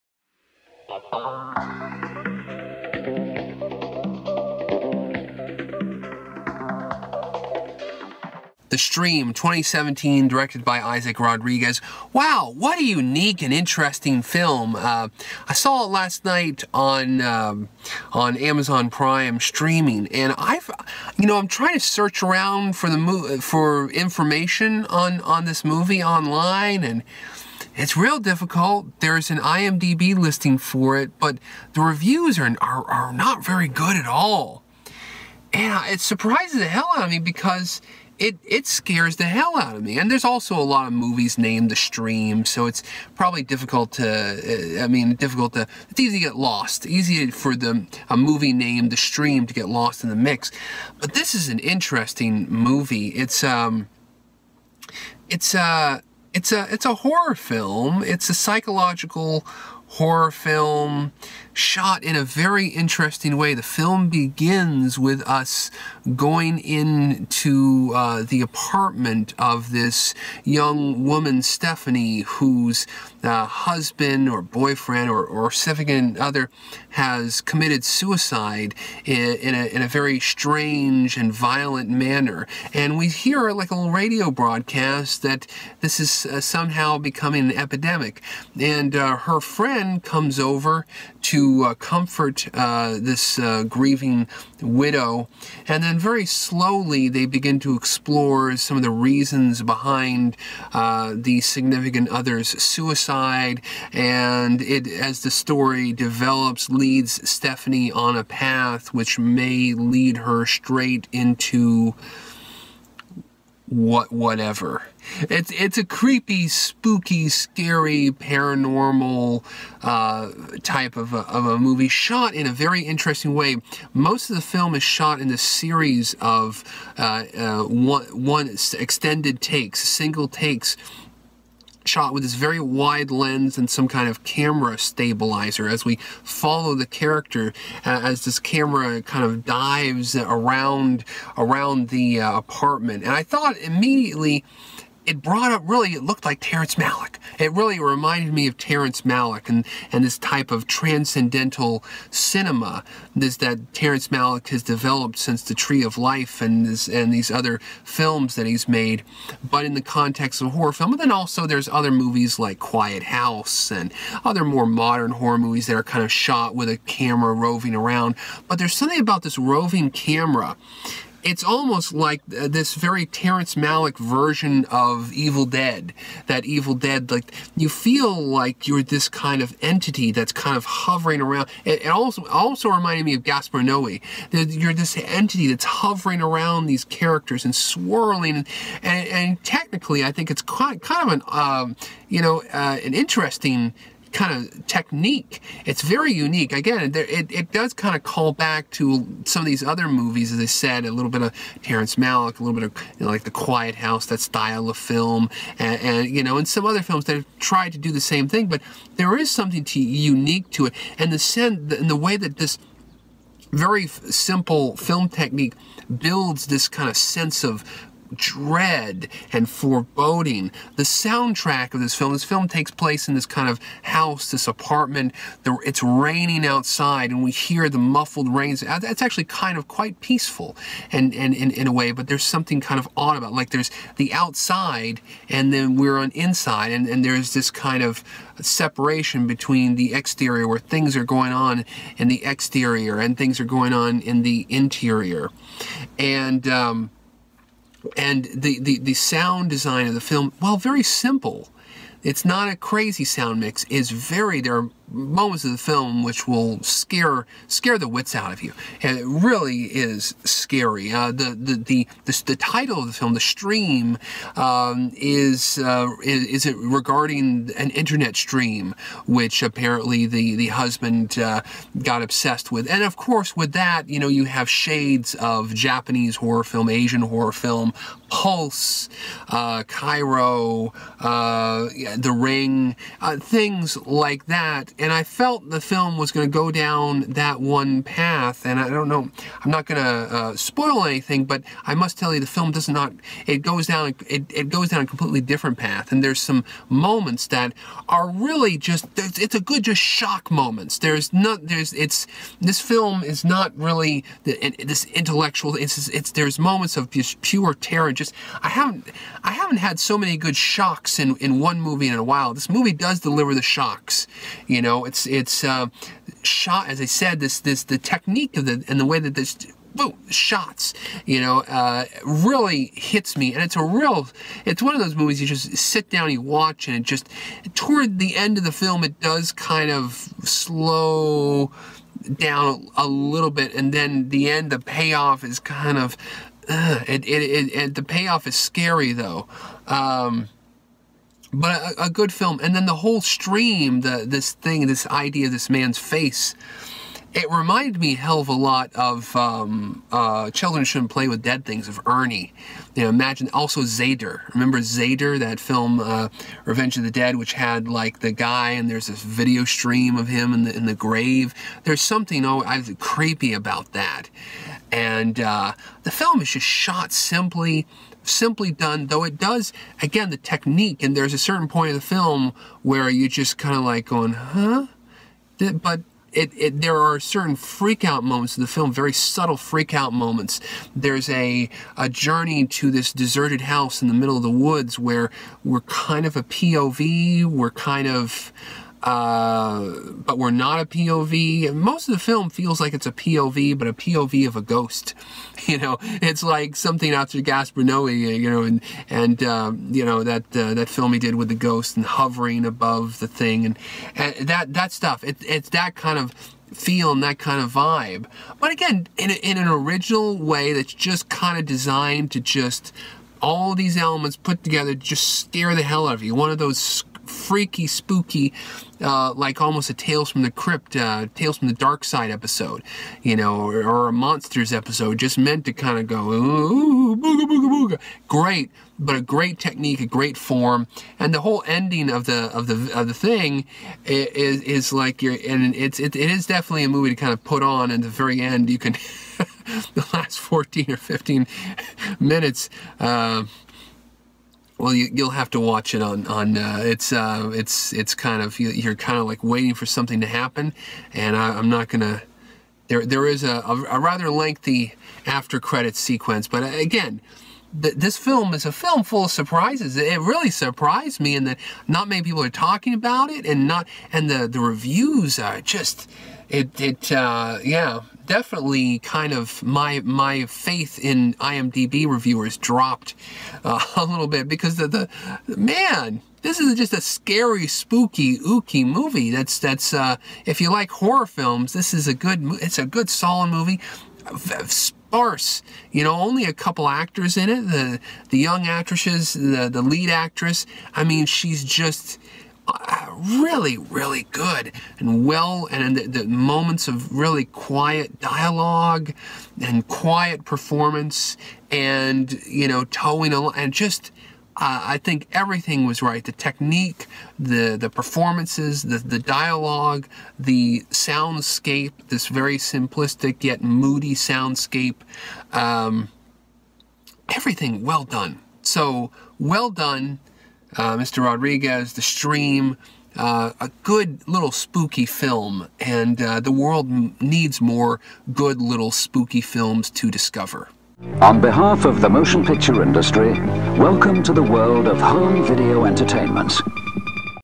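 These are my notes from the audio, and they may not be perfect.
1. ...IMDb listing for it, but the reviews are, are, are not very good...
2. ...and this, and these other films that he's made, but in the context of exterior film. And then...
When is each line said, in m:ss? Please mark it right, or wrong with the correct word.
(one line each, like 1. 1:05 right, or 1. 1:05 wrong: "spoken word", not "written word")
1. 0:29 right
2. 2:36 wrong: "horror", not "exterior".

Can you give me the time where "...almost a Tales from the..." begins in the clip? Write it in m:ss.
6:59.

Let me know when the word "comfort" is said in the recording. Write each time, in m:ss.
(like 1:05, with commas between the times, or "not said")
1:31.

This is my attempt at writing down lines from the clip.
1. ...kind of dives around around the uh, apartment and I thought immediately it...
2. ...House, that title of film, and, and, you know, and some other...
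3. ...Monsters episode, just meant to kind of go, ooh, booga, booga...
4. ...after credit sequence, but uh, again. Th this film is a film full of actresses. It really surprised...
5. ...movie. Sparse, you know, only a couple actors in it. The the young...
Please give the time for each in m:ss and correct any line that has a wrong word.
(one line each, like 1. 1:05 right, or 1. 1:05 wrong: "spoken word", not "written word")
1. 2:19 right
2. 3:23 wrong: "style", not "title"
3. 7:03 right
4. 7:35 wrong: "surprises", not "actresses"
5. 8:03 right.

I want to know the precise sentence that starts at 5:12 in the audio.
This movie does deliver the shocks, you know, know, it's it's uh, shot as I said.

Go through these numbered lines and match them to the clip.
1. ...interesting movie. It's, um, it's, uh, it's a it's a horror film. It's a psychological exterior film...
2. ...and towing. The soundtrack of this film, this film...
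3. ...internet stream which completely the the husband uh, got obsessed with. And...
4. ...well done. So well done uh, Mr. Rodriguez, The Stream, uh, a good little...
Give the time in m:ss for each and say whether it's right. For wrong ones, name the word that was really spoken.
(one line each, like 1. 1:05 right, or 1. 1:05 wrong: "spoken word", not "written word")
1. 0:51 wrong: "horror", not "exterior"
2. 3:39 wrong: "foreboding", not "towing"
3. 4:27 wrong: "apparently", not "completely"
4. 8:37 right.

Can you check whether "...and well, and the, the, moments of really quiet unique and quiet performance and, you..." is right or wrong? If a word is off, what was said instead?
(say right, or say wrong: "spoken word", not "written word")
wrong: "dialogue", not "unique".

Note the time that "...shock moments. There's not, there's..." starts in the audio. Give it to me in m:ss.
4:59.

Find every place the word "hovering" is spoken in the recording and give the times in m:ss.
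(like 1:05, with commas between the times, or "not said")
3:00, 3:05, 6:41.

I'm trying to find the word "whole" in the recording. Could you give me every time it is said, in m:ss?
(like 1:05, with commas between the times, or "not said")
5:42, 7:11.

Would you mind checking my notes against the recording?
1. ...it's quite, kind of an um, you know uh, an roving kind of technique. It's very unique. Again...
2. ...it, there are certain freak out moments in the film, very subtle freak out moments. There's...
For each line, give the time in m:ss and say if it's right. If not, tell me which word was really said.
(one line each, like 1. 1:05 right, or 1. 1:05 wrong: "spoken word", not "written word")
1. 3:10 wrong: "interesting", not "roving"
2. 6:16 right.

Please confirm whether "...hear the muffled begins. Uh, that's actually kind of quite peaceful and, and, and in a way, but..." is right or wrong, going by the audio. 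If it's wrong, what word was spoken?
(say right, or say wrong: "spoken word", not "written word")
wrong: "rains", not "begins".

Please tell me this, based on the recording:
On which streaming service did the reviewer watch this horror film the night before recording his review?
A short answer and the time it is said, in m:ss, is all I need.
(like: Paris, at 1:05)
Amazon Prime, at 0:18.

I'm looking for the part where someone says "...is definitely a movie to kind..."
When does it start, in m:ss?
7:16.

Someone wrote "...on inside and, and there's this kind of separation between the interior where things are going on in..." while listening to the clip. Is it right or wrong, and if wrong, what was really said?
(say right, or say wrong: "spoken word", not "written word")
wrong: "exterior", not "interior".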